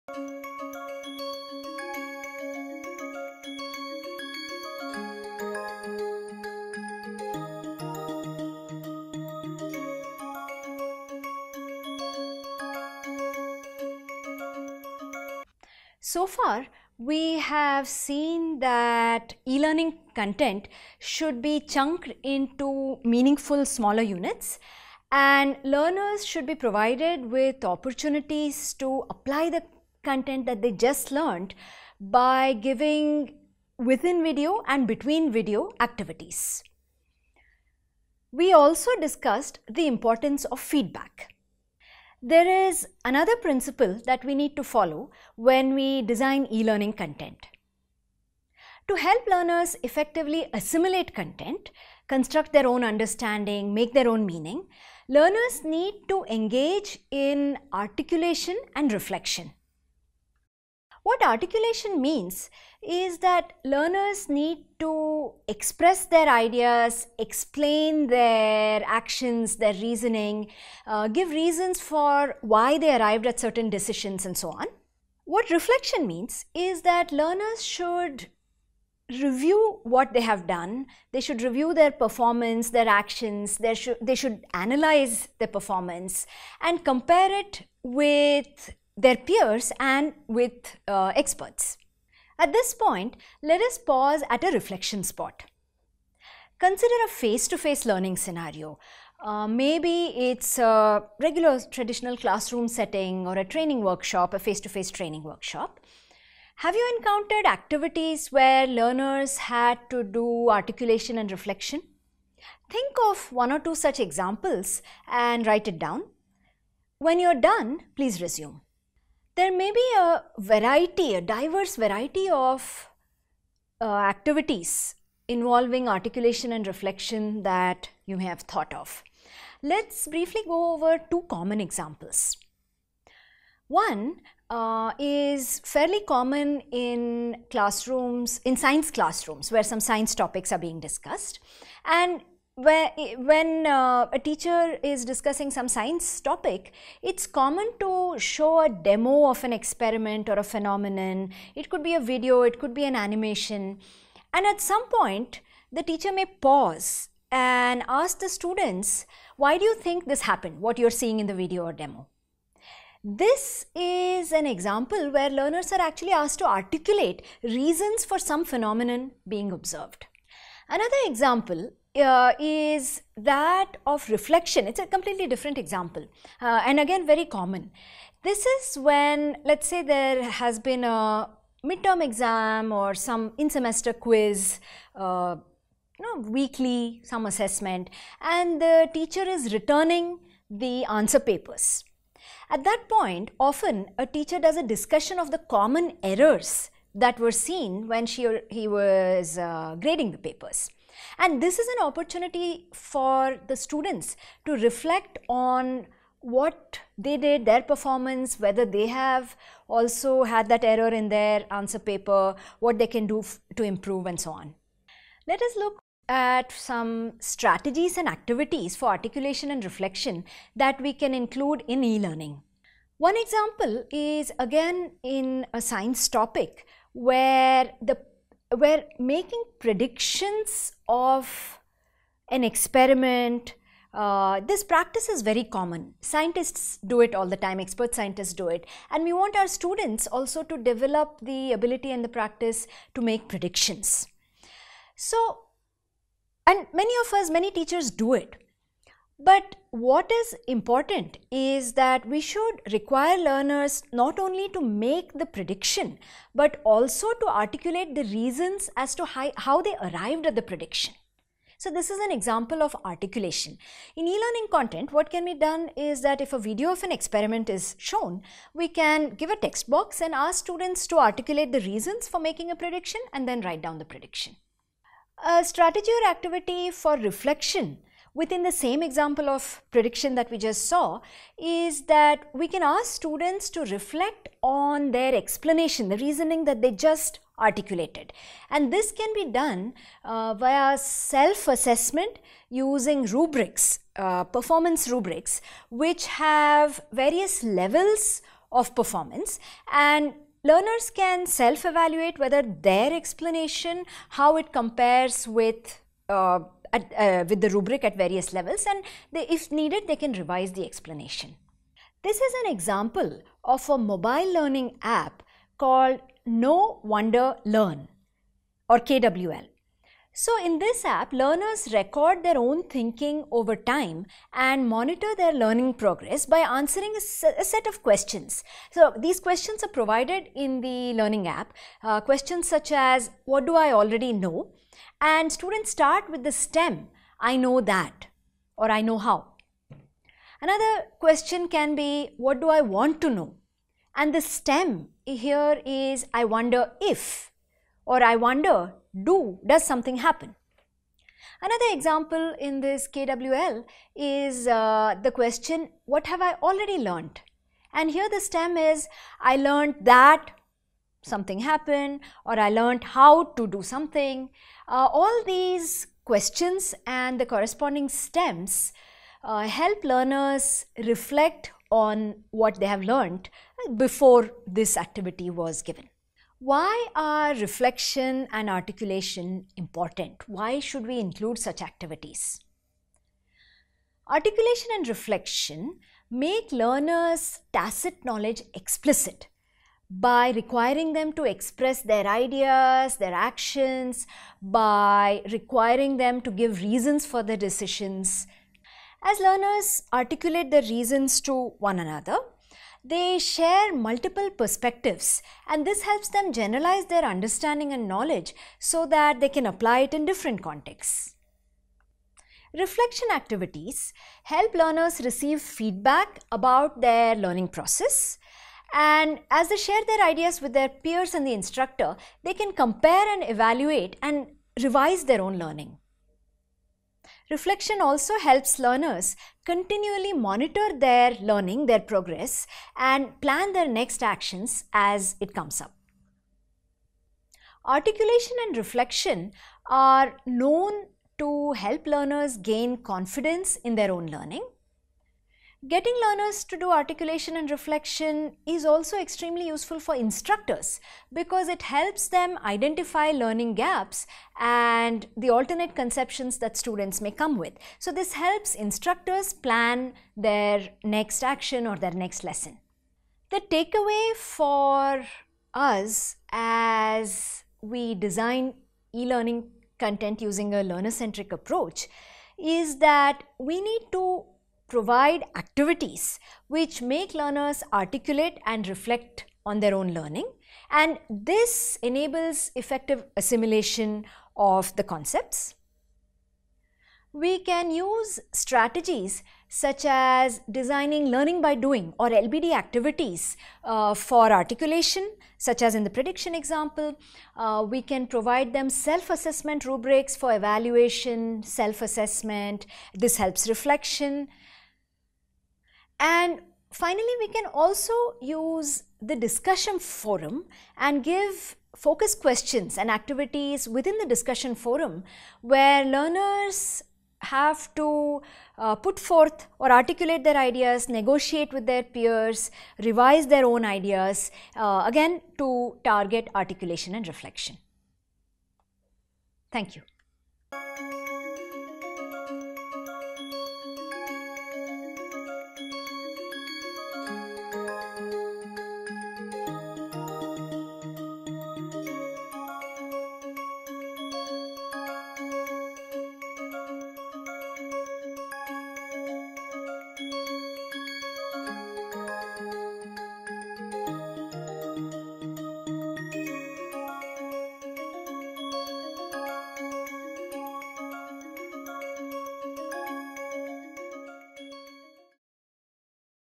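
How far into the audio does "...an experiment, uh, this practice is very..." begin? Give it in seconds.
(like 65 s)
232 s.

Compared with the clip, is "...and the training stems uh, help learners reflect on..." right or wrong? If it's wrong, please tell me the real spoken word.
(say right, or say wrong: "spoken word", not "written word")
wrong: "corresponding", not "training".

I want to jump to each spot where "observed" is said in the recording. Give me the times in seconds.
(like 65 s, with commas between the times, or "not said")
169 s.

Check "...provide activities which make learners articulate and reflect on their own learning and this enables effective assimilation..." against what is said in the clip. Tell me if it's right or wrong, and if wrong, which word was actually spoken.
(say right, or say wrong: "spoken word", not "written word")
right.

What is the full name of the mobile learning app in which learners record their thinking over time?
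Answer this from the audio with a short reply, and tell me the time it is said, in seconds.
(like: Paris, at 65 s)
Know Wonder Learn, at 316 s.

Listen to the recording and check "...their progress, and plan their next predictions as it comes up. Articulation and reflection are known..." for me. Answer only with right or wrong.
wrong.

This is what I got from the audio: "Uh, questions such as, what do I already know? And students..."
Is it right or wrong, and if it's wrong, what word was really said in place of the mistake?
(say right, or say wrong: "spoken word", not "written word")
right.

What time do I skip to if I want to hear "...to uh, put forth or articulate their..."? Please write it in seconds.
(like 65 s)
517 s.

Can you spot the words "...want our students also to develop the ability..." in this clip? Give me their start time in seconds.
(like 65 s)
239 s.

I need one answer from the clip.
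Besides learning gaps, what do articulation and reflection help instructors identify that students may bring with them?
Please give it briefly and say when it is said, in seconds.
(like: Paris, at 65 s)
Alternate conceptions, at 455 s.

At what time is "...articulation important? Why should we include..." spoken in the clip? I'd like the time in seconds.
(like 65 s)
378 s.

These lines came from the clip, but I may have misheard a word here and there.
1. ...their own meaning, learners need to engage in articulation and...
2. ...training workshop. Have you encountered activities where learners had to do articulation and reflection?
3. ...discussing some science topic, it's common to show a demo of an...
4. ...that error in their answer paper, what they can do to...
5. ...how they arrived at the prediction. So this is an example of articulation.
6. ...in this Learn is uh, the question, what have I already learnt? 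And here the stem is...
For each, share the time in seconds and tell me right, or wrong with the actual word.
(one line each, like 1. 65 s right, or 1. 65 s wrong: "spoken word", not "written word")
1. 53 s right
2. 104 s right
3. 145 s right
4. 210 s right
5. 259 s right
6. 352 s wrong: "KWL", not "Learn".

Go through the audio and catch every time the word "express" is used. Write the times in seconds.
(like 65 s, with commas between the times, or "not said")
65 s, 391 s.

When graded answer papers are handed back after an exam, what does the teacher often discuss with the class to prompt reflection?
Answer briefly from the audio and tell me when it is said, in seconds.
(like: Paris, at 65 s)
Common errors, at 195 s.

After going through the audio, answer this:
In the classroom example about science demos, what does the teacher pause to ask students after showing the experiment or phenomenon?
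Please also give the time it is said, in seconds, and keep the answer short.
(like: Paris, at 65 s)
Why do you think this happened, at 159 s.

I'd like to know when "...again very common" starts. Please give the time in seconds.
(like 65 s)
176 s.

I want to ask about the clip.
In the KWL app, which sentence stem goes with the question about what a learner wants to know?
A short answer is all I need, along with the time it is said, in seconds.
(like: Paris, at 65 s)
I wonder if, at 346 s.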